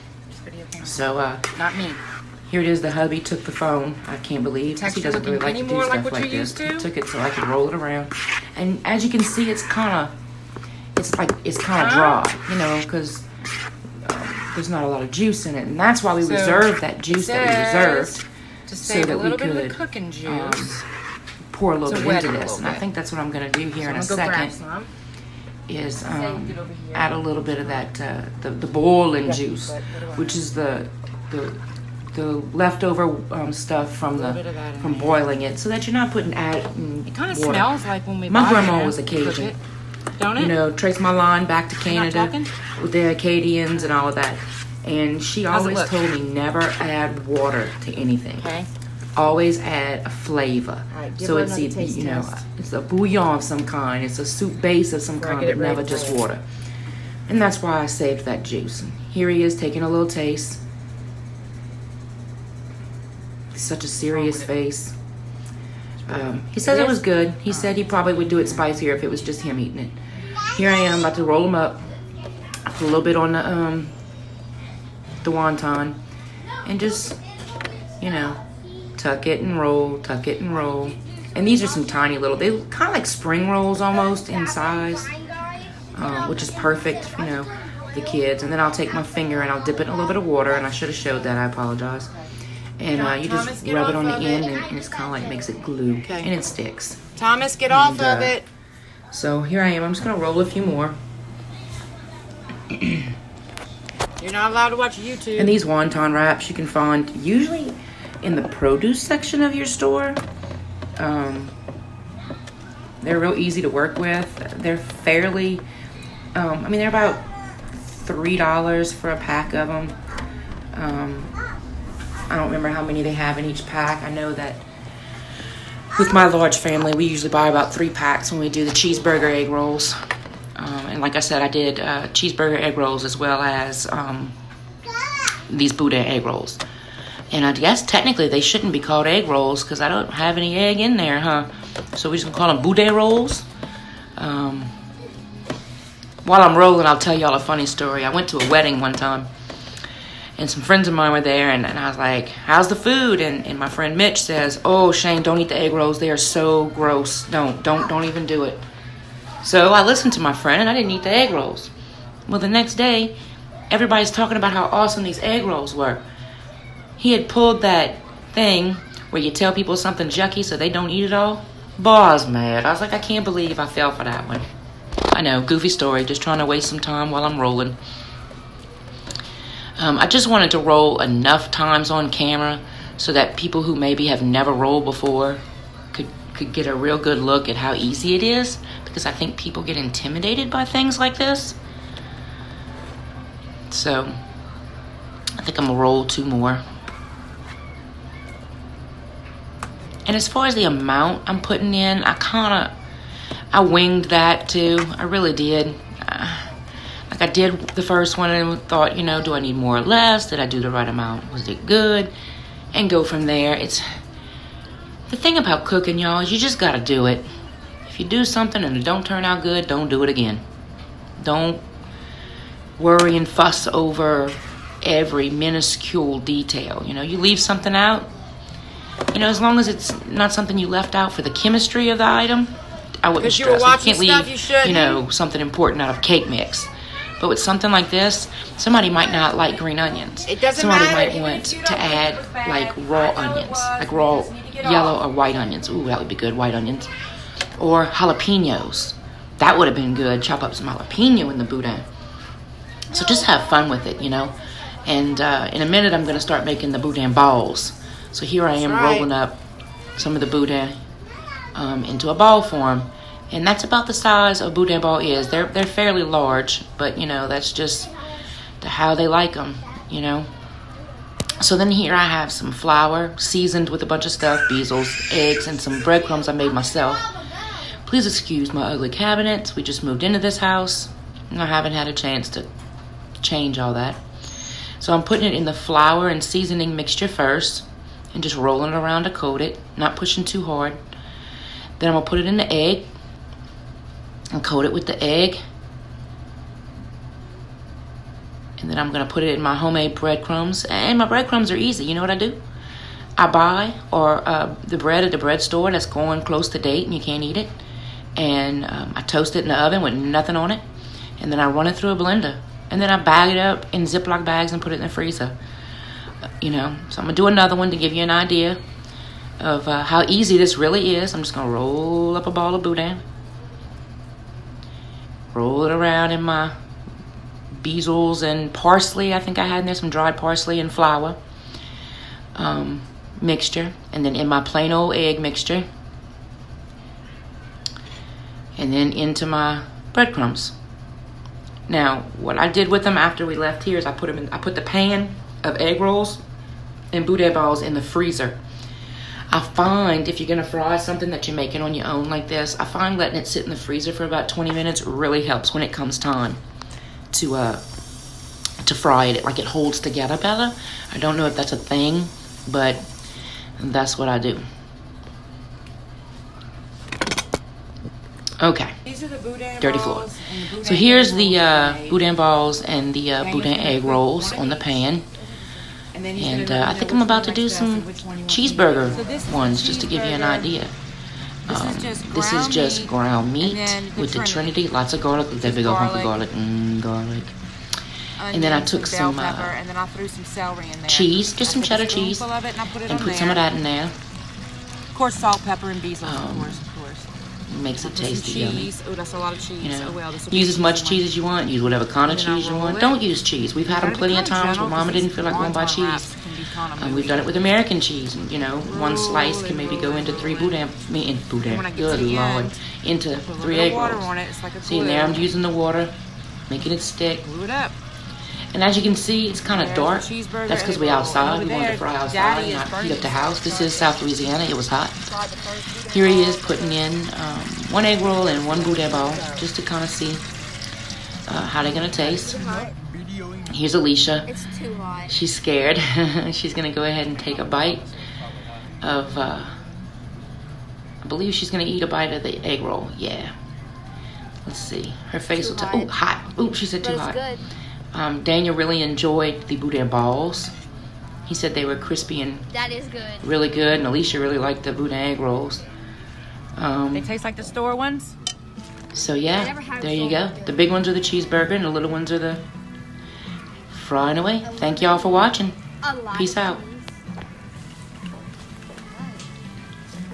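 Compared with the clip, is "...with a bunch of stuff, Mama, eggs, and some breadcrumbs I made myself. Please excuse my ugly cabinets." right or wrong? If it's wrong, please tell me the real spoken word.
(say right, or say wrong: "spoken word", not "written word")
wrong: "Beazells", not "Mama".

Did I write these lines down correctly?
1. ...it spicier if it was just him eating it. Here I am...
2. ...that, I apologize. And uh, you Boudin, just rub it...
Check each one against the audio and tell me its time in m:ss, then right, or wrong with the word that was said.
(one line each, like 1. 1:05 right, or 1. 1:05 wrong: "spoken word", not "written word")
1. 1:08 right
2. 1:31 wrong: "Thomas", not "Boudin".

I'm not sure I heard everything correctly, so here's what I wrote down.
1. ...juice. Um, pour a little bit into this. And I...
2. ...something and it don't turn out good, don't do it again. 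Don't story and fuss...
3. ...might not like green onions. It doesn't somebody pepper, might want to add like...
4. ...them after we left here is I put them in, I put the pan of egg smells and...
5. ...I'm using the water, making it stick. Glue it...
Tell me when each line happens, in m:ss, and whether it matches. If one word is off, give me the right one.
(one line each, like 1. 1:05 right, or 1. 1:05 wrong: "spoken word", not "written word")
1. 0:20 right
2. 3:38 wrong: "worry", not "story"
3. 3:58 wrong: "matter", not "pepper"
4. 5:42 wrong: "rolls", not "smells"
5. 6:55 right.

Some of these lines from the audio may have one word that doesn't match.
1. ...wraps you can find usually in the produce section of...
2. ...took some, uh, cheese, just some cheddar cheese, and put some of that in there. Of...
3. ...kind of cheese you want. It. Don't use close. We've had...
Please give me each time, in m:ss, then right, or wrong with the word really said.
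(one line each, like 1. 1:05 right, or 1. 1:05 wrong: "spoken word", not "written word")
1. 1:46 right
2. 6:28 right
3. 6:41 wrong: "cheese", not "close".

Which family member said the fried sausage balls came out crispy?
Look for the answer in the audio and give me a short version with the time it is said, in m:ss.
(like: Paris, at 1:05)
Daniel, at 7:28.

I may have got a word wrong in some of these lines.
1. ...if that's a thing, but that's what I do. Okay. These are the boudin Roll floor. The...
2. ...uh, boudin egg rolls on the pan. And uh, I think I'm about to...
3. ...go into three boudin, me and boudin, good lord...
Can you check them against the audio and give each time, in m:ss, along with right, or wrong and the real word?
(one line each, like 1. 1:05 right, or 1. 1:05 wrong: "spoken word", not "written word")
1. 6:01 wrong: "Dirty", not "Roll"
2. 6:13 right
3. 6:49 right.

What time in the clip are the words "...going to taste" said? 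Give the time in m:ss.
7:11.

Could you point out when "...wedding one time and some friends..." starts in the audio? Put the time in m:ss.
2:28.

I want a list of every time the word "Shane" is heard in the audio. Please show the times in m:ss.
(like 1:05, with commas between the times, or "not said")
2:34.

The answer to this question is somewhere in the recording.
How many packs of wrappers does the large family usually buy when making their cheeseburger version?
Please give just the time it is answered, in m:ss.
2:07.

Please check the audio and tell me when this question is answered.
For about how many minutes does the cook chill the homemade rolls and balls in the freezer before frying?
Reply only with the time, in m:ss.
5:54.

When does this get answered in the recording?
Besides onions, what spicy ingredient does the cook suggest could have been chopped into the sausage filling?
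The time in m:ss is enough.
4:07.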